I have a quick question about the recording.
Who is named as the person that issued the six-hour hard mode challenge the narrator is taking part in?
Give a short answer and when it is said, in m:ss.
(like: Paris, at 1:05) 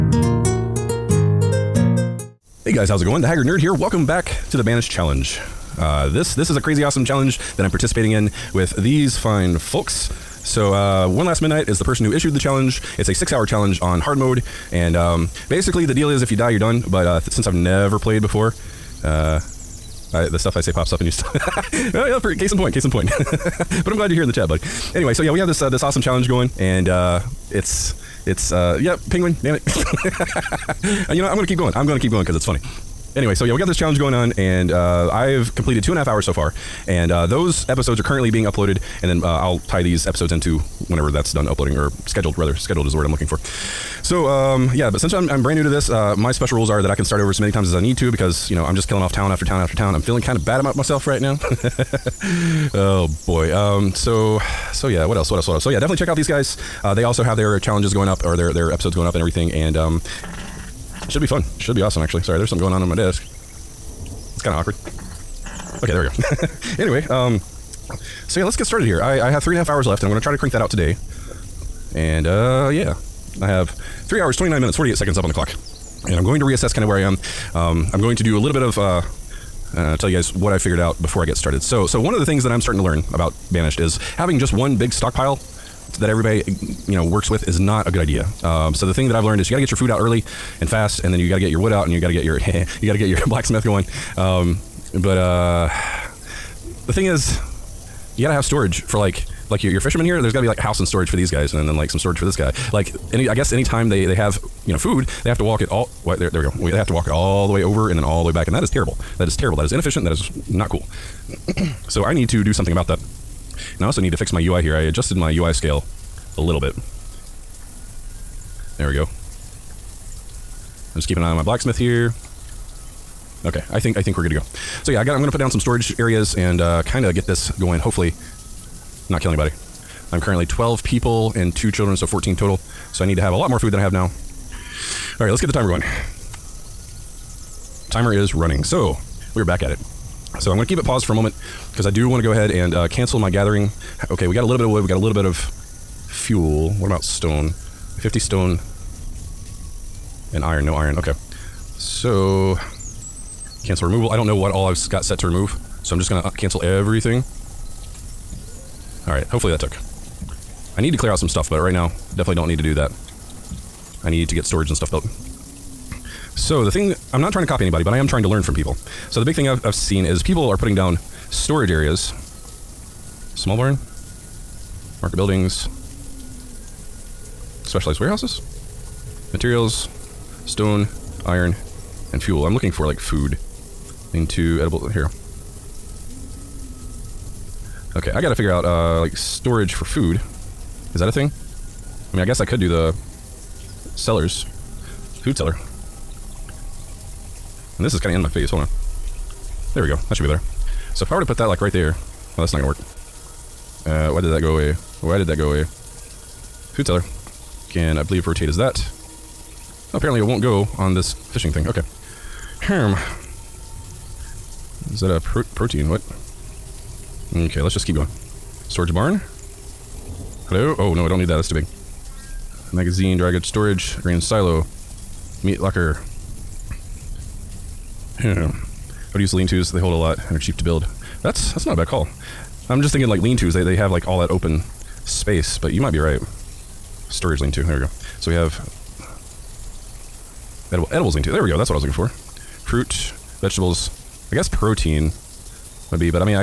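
One Last Midnight, at 0:11.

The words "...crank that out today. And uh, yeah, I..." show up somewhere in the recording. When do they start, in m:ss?
1:10.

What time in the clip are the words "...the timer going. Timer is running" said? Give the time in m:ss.
2:15.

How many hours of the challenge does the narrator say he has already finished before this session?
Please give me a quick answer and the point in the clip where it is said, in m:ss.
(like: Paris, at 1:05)
2.5, at 0:35.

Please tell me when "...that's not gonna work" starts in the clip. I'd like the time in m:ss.
3:22.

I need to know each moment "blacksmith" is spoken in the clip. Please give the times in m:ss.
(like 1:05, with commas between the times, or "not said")
1:33, 2:01.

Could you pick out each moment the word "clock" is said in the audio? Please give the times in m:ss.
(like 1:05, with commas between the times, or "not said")
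1:15.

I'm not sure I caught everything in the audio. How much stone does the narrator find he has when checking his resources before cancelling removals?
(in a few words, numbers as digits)
50.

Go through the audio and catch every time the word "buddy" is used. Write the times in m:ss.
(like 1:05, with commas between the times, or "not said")
0:24.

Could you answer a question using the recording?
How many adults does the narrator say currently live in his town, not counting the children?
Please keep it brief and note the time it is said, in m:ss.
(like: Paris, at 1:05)
12, at 2:10.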